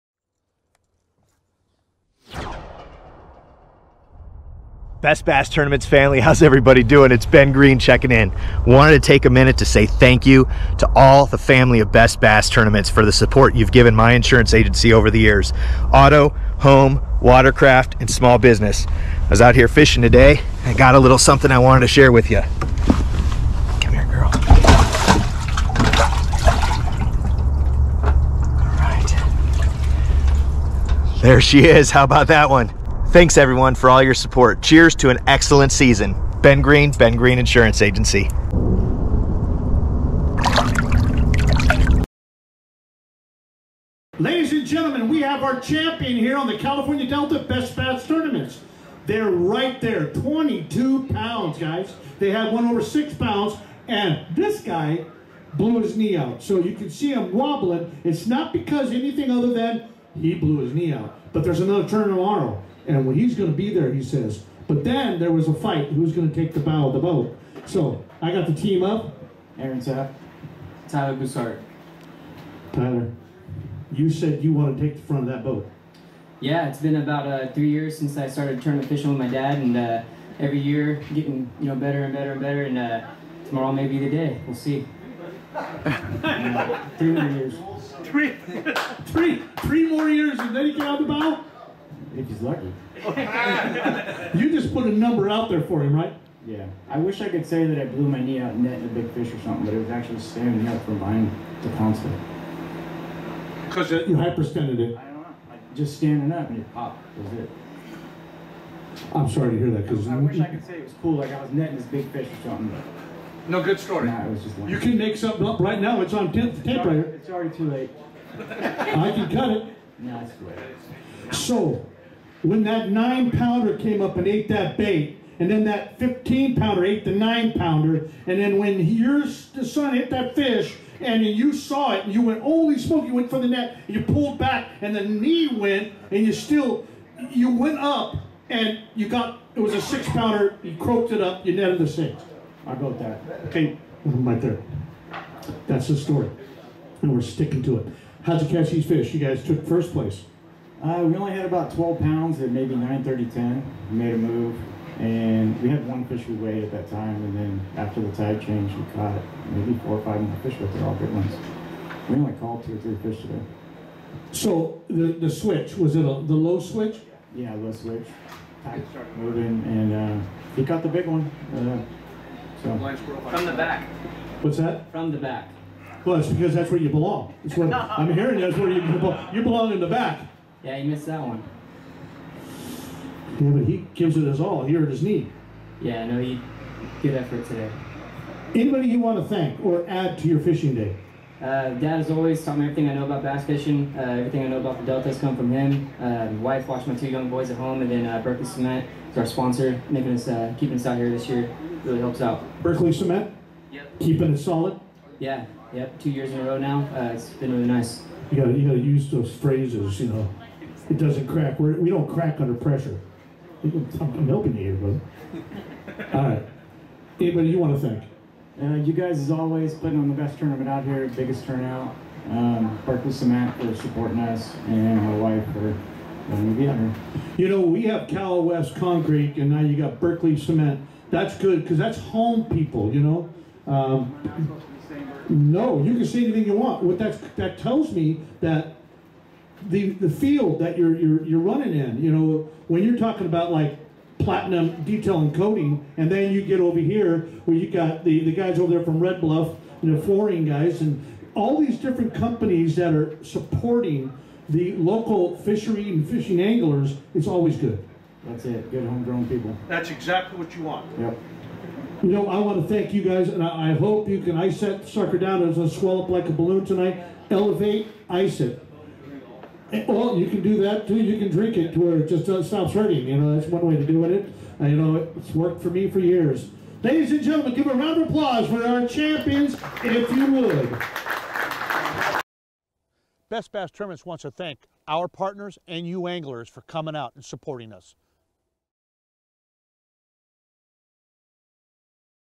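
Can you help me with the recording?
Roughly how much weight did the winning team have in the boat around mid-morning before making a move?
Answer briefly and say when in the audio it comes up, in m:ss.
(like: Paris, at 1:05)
12 pounds, at 2:31.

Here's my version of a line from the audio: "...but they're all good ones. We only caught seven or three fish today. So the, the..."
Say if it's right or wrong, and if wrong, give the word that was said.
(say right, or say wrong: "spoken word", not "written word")
wrong: "two", not "seven".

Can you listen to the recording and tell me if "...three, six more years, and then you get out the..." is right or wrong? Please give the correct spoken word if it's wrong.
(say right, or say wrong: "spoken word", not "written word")
wrong: "three", not "six".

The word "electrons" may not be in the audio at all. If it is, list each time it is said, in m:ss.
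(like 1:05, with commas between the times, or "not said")
not said.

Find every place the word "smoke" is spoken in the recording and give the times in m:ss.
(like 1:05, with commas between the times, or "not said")
2:12.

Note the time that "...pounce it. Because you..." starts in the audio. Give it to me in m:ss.
1:41.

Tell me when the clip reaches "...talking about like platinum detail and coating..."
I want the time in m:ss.
4:02.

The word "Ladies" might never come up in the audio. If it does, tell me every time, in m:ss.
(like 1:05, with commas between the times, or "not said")
0:44, 4:36.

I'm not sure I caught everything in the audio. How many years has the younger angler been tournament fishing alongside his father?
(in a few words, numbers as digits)
3 years.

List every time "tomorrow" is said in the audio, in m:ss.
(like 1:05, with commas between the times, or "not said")
1:02, 1:23.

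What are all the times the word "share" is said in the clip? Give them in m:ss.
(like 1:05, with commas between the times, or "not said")
0:21.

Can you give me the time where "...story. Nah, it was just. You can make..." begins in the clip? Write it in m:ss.
1:53.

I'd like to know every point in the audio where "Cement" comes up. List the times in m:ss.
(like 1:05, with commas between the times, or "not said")
3:18, 3:22, 3:43, 3:50.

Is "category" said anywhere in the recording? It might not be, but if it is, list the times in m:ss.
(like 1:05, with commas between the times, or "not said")
not said.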